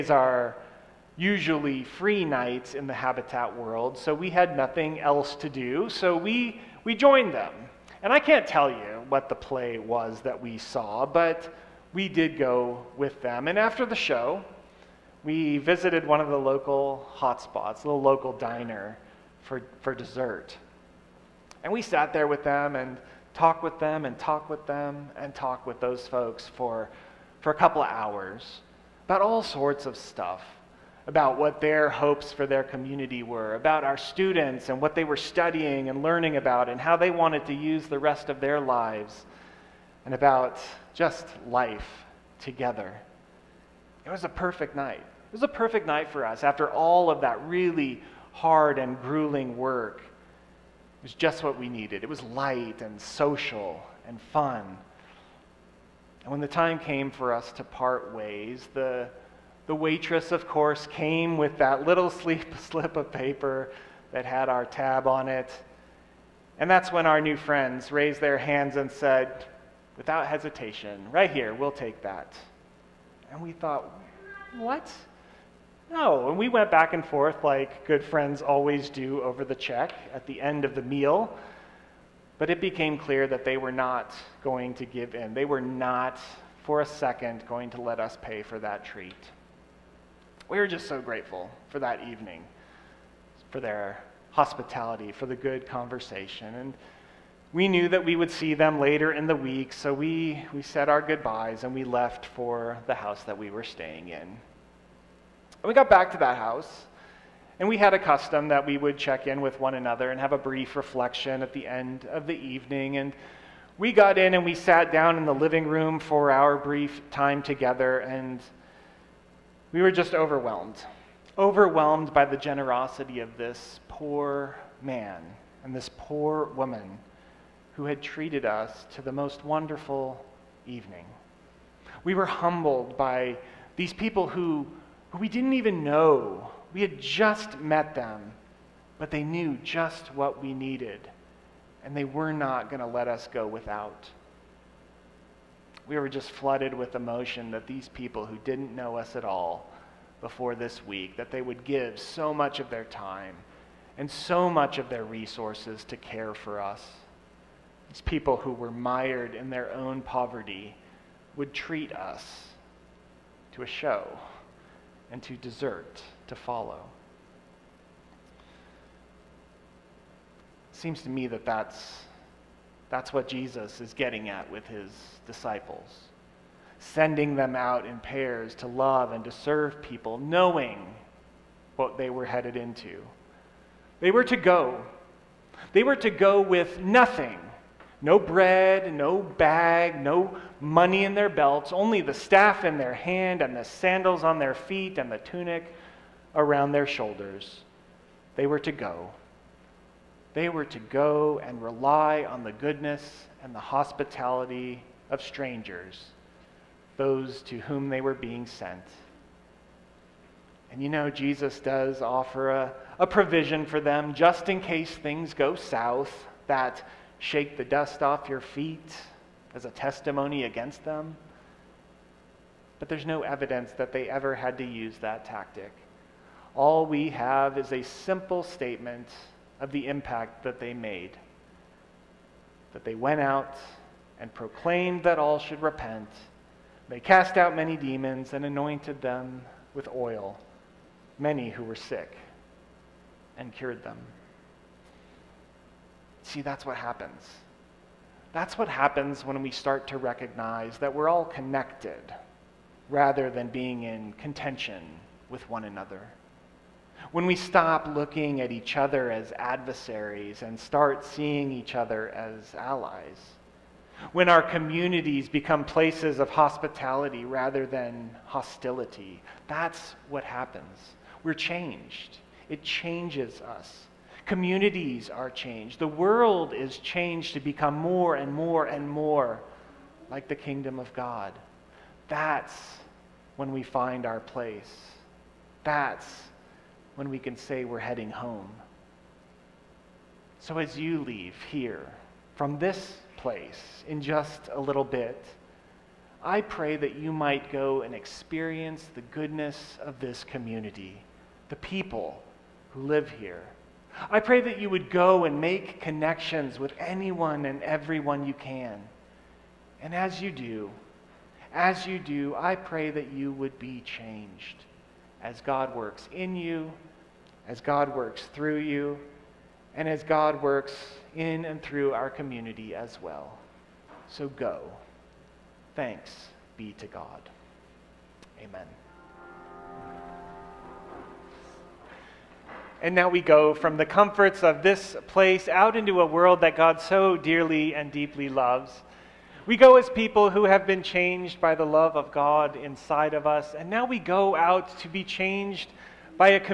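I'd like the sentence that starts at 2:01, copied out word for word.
Overwhelmed by the generosity of this poor man and this poor woman who had treated us to the most wonderful evening.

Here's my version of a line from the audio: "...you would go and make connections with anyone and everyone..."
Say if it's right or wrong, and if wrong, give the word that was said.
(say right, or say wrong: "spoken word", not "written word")
right.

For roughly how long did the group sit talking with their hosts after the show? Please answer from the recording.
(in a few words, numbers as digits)
a couple of hours.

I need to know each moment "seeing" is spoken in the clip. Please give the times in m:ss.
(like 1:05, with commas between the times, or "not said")
4:21.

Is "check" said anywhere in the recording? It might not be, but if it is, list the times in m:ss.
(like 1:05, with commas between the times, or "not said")
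1:19, 1:48.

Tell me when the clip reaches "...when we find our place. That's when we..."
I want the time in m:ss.
4:43.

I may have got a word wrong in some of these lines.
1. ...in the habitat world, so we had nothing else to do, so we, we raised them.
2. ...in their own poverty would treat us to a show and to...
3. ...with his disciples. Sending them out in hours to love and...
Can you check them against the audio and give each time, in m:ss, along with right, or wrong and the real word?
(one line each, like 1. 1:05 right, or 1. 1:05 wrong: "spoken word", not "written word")
1. 0:02 wrong: "joined", not "raised"
2. 2:39 right
3. 2:54 wrong: "pairs", not "hours".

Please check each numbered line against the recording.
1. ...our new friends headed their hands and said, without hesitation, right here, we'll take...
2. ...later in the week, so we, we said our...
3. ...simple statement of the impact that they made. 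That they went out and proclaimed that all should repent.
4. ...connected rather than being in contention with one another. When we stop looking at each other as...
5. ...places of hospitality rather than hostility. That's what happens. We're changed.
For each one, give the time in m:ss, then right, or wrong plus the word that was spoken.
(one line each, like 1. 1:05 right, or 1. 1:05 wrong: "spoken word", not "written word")
1. 1:07 wrong: "raised", not "headed"
2. 1:38 right
3. 3:47 right
4. 4:11 right
5. 4:25 right.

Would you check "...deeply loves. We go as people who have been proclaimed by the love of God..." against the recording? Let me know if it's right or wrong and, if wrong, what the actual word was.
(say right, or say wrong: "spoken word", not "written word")
wrong: "changed", not "proclaimed".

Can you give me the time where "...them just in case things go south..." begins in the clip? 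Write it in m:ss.
3:33.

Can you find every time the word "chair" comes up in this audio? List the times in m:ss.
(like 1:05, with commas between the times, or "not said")
not said.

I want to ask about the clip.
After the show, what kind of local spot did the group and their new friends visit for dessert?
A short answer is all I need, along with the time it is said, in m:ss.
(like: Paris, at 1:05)
diner, at 0:17.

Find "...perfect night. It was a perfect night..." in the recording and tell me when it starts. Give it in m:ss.
0:44.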